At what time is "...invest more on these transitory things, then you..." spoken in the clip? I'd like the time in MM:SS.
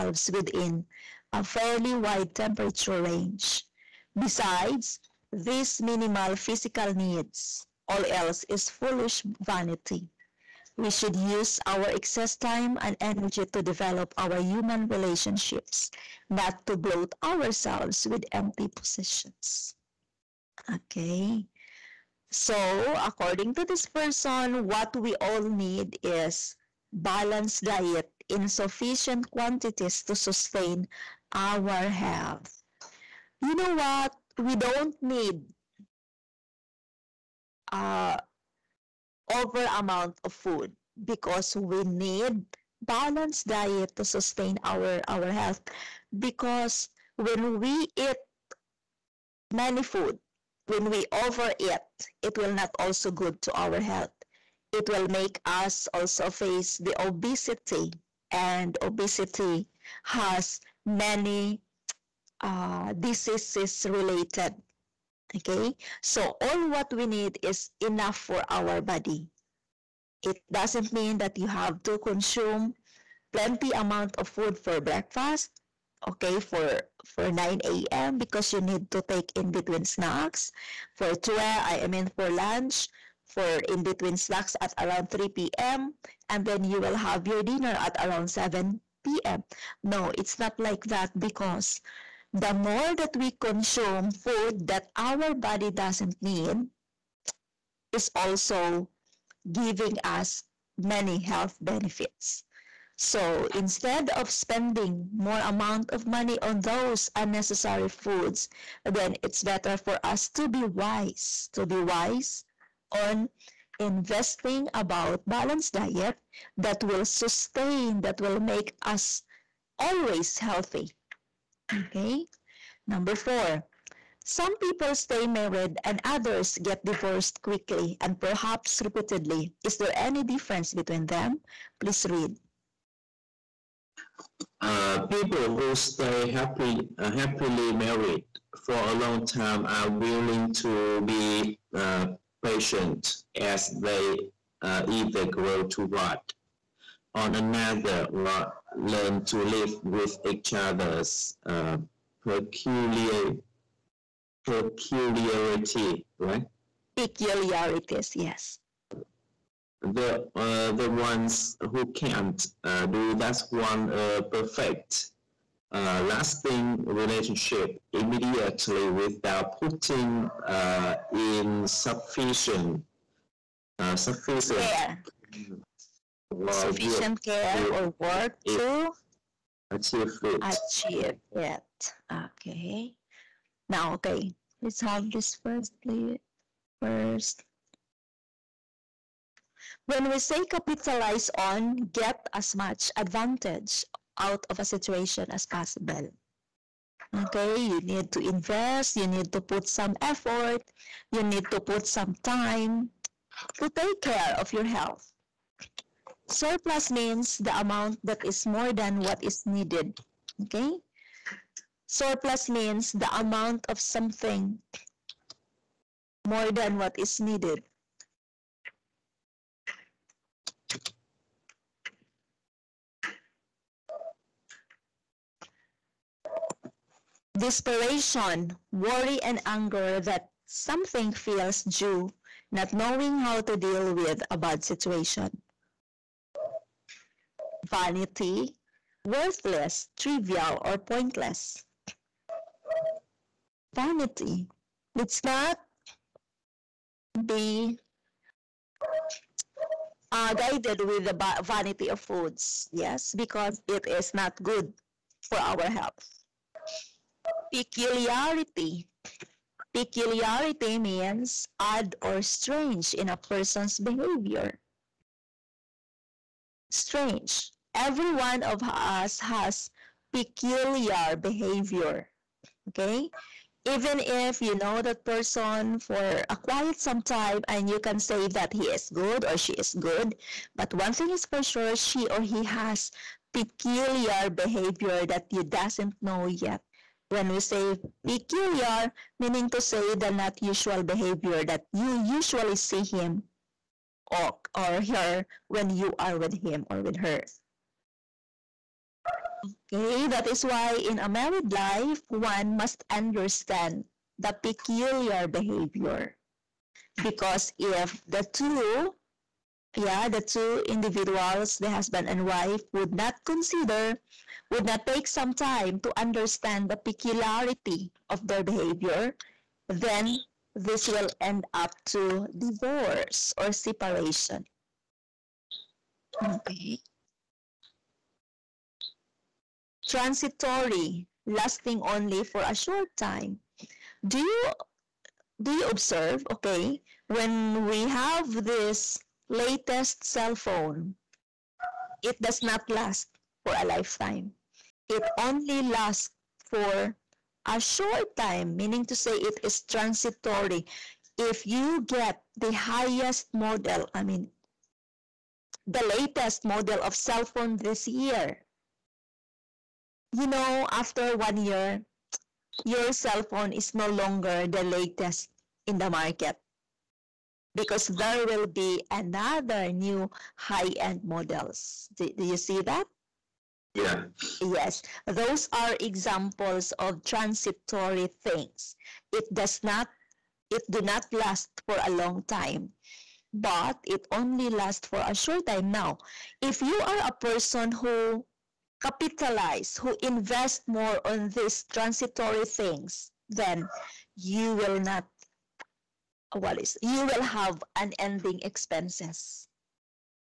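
06:30.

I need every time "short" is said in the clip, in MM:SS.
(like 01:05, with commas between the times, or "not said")
05:32, 05:47, 06:25.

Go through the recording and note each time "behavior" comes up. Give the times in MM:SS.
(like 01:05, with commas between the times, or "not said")
04:23, 04:31, 04:44, 04:50, 05:05, 05:18.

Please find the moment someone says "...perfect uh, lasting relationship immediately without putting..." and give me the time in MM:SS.
02:44.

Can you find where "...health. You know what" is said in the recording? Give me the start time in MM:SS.
00:31.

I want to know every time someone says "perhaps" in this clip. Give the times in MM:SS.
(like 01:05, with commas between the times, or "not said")
02:08.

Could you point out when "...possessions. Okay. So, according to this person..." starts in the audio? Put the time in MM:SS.
00:18.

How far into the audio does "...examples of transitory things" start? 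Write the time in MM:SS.
06:15.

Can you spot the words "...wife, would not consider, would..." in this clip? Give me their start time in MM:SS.
05:12.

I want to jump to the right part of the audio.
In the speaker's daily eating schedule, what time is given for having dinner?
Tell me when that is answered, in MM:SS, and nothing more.
01:28.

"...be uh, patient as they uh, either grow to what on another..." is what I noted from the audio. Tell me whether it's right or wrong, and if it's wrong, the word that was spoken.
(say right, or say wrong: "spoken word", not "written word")
right.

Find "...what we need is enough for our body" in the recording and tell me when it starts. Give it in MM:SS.
01:06.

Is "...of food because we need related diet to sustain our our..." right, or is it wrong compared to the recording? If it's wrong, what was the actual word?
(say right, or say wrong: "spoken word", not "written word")
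wrong: "balanced", not "related".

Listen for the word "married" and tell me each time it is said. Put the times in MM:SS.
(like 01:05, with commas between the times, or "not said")
02:05, 02:17, 05:01.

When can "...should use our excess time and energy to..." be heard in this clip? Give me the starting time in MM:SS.
00:10.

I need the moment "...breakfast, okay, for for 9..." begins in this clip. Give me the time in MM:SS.
01:14.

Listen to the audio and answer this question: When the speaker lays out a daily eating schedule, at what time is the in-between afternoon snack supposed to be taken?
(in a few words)
3 p.m.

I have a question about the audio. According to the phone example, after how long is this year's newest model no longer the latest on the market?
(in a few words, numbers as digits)
1 year.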